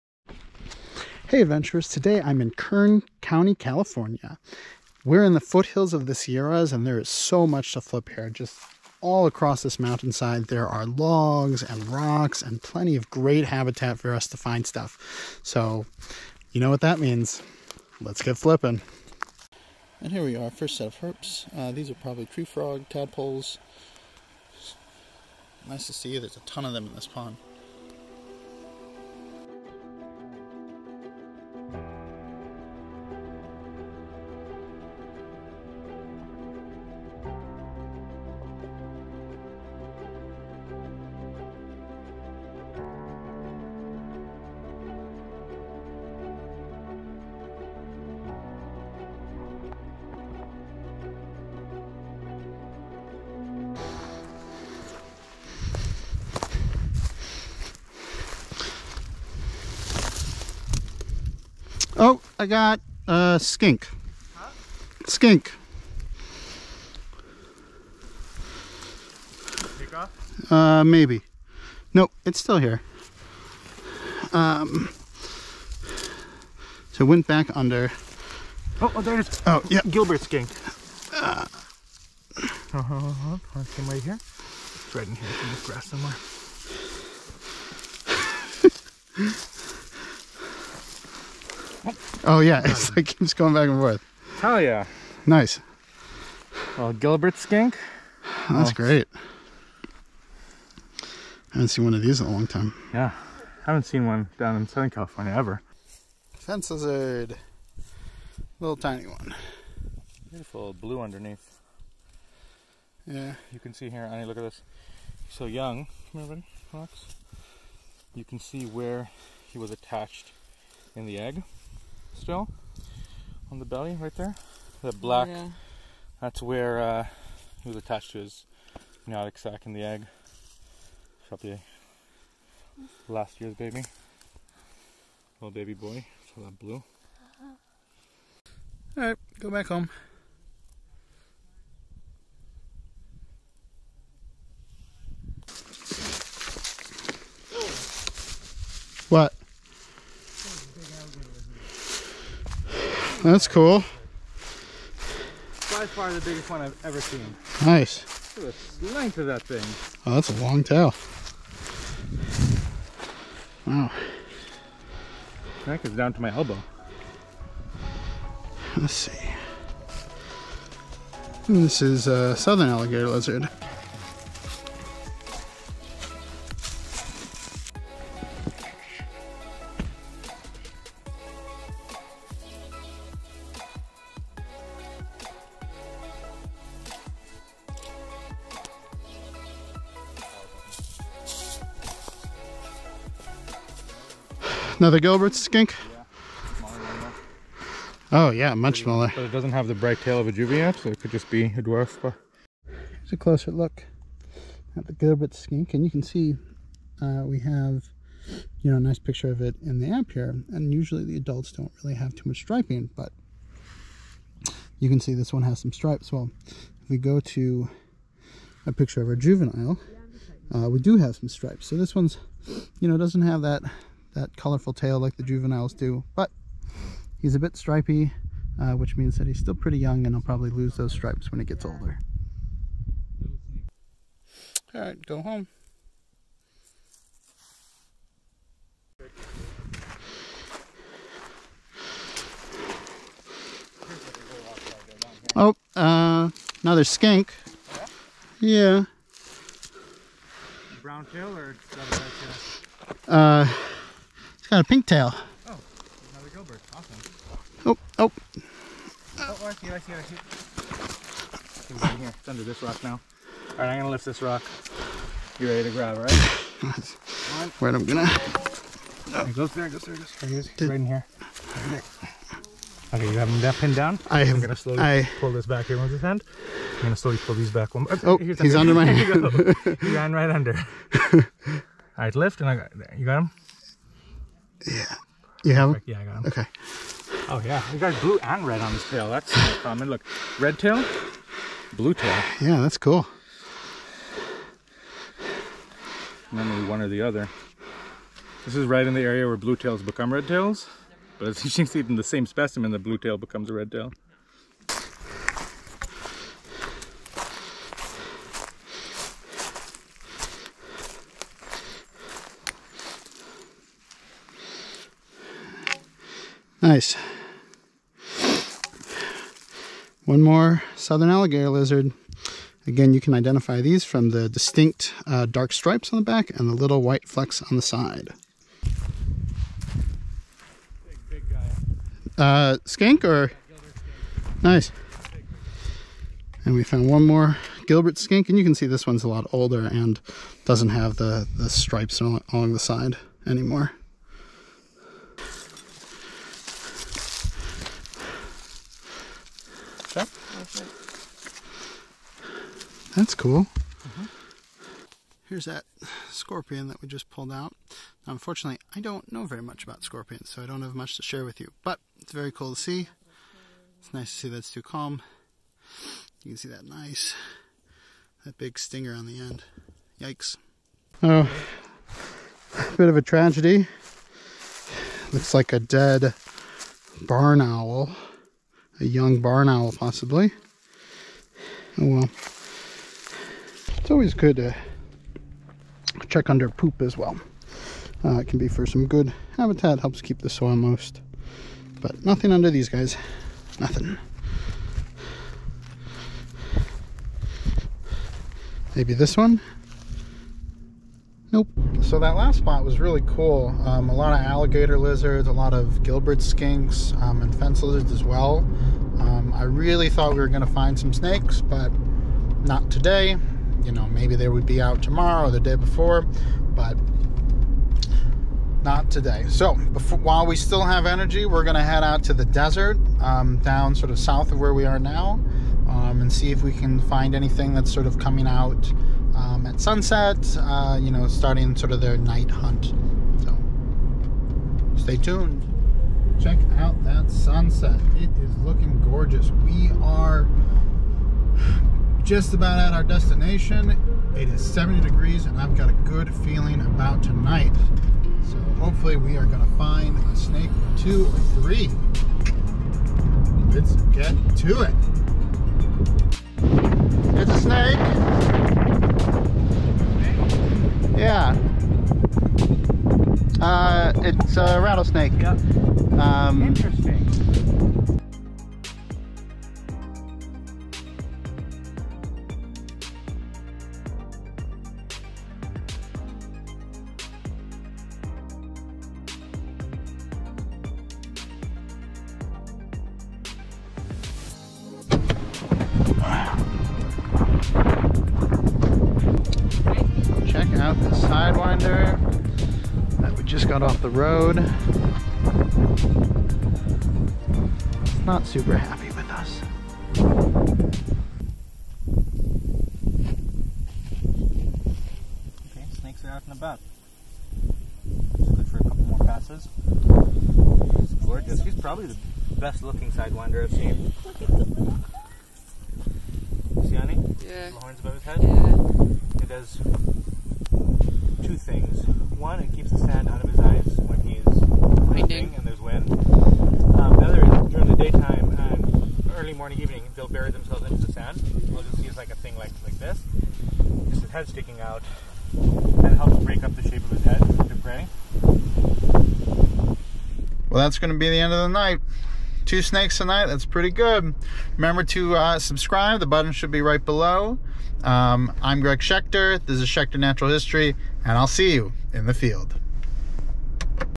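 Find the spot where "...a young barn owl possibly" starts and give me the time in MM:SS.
06:18.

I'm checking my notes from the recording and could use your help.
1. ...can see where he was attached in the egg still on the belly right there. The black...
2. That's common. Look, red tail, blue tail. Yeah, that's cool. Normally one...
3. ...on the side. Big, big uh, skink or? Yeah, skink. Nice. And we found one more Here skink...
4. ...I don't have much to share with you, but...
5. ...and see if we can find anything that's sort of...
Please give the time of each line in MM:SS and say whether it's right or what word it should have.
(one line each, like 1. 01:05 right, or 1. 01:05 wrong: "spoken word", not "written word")
1. 01:58 right
2. 04:49 right
3. 05:27 wrong: "Gilbert", not "Here"
4. 06:00 right
5. 07:06 right.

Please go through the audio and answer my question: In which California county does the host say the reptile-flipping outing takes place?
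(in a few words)
Kern County.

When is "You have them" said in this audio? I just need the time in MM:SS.
04:45.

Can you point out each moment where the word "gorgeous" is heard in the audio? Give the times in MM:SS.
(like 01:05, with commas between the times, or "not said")
07:18, 08:31.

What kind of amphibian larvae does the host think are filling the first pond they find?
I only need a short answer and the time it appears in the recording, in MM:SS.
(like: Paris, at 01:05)
Tree frog tadpoles, at 00:22.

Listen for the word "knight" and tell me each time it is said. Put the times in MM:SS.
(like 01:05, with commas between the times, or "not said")
not said.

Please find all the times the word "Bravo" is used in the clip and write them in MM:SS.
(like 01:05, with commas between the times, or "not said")
not said.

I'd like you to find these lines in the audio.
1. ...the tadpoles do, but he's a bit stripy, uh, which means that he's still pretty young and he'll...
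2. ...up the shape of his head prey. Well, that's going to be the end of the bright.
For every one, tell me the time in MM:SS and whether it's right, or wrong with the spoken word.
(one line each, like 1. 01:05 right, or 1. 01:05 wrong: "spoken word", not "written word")
1. 03:45 wrong: "juveniles", not "tadpoles"
2. 08:56 wrong: "night", not "bright".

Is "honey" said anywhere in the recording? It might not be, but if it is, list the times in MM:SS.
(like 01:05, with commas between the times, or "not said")
01:54, 08:36.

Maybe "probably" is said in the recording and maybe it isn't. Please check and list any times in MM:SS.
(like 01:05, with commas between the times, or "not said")
00:21, 02:11, 03:50, 08:31.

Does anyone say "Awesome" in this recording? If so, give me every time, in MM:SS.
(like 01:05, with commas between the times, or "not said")
04:16.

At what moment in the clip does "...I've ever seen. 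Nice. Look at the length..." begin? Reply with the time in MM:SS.
02:36.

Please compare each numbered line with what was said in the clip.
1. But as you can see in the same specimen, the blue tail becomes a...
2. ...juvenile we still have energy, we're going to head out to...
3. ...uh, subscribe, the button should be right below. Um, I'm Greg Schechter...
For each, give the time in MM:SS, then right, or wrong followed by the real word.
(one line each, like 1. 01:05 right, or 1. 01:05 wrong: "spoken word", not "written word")
1. 05:01 right
2. 06:59 wrong: "while", not "juvenile"
3. 09:05 right.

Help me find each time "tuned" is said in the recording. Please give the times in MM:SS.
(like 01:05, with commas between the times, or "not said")
07:14.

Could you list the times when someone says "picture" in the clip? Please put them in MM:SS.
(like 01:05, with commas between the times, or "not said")
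03:28, 03:38.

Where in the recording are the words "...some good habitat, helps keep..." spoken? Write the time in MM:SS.
06:28.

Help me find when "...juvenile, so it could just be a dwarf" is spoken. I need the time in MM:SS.
03:20.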